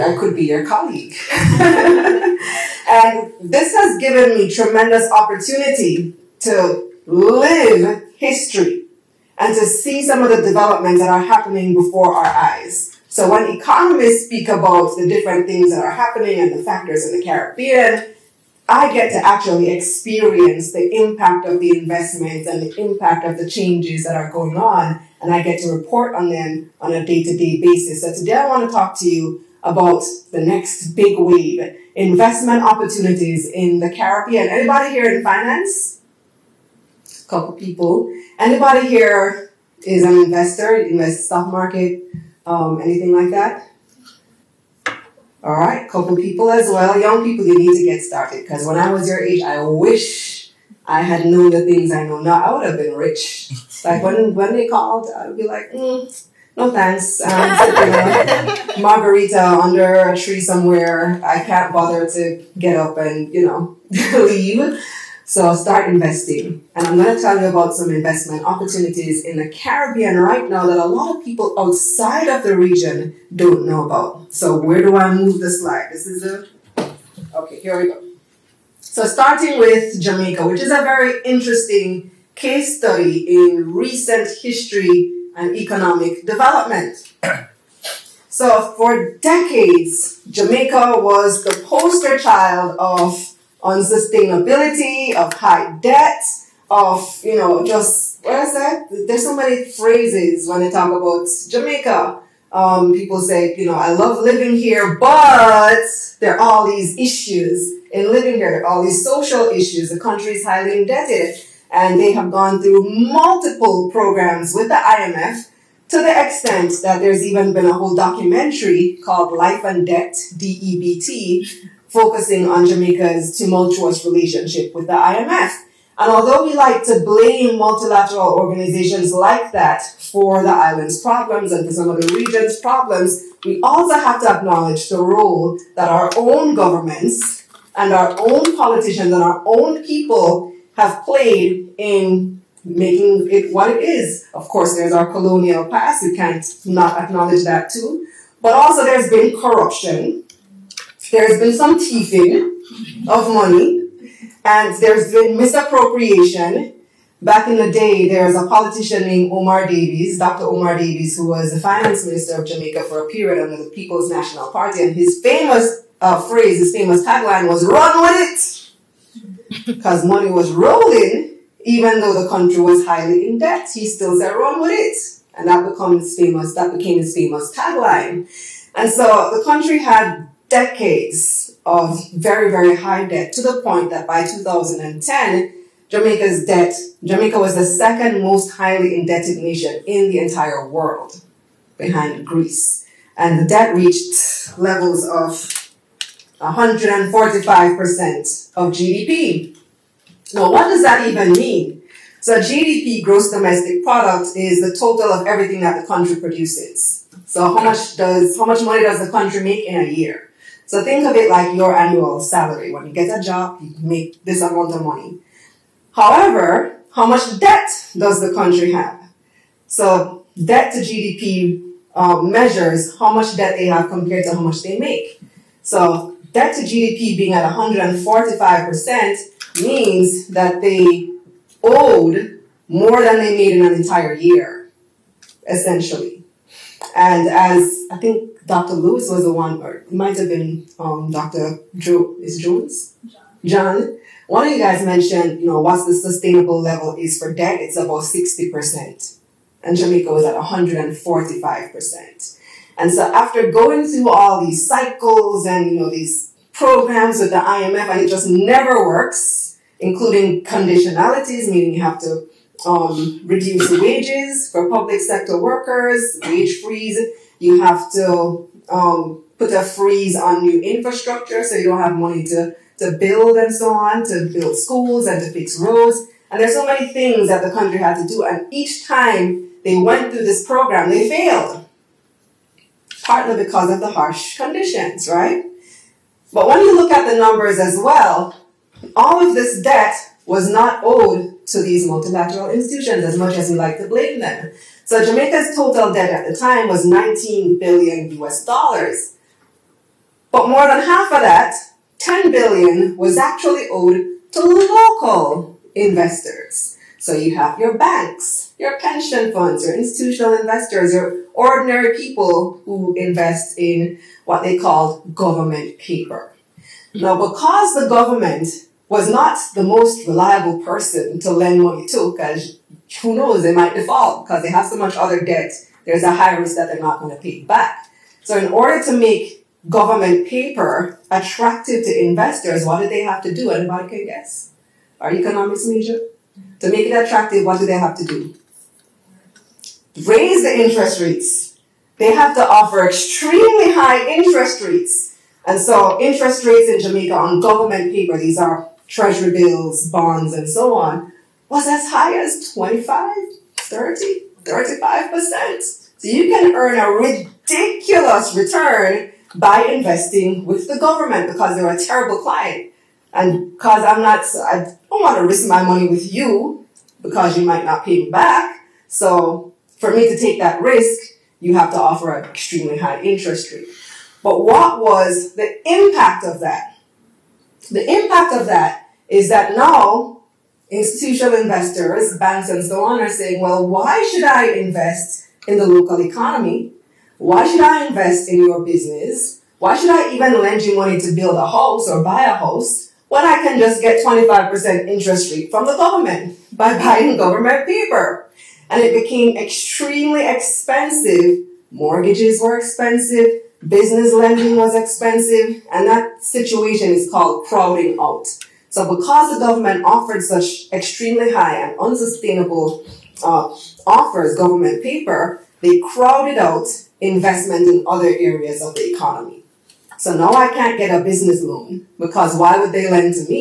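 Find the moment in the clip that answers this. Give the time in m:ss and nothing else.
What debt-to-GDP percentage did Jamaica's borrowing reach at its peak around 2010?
3:16.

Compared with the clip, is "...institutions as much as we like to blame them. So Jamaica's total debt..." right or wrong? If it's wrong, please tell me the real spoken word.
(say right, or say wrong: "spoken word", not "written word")
right.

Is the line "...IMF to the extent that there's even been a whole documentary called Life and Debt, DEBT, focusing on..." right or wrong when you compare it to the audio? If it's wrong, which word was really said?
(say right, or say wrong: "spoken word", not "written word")
right.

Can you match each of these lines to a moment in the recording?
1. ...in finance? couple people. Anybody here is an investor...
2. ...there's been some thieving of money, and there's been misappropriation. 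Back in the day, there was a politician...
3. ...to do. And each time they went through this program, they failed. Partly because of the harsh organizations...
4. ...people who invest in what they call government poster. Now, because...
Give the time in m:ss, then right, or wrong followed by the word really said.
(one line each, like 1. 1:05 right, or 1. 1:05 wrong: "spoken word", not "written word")
1. 0:35 right
2. 2:31 right
3. 4:38 wrong: "conditions", not "organizations"
4. 5:11 wrong: "paper", not "poster".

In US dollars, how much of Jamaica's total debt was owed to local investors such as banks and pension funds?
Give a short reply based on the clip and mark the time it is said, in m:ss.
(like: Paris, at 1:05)
10 billion, at 5:01.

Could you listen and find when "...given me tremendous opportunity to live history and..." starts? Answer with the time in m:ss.
0:04.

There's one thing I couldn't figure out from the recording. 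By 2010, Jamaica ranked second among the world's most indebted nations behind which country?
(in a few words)
Greece.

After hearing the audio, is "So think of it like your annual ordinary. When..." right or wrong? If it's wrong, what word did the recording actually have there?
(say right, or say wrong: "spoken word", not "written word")
wrong: "salary", not "ordinary".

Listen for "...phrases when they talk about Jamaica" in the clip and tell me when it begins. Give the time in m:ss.
1:39.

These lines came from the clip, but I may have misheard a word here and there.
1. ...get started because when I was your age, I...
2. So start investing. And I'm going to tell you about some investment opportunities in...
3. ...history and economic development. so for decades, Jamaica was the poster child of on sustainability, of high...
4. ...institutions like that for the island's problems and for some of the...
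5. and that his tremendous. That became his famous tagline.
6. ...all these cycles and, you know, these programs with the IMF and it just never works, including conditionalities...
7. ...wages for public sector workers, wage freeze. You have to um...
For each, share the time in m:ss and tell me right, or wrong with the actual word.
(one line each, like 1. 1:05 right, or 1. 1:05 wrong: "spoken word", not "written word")
1. 0:47 right
2. 1:05 right
3. 1:24 right
4. 2:08 wrong: "organizations", not "institutions"
5. 2:55 wrong: "famous", not "tremendous"
6. 4:14 right
7. 4:23 right.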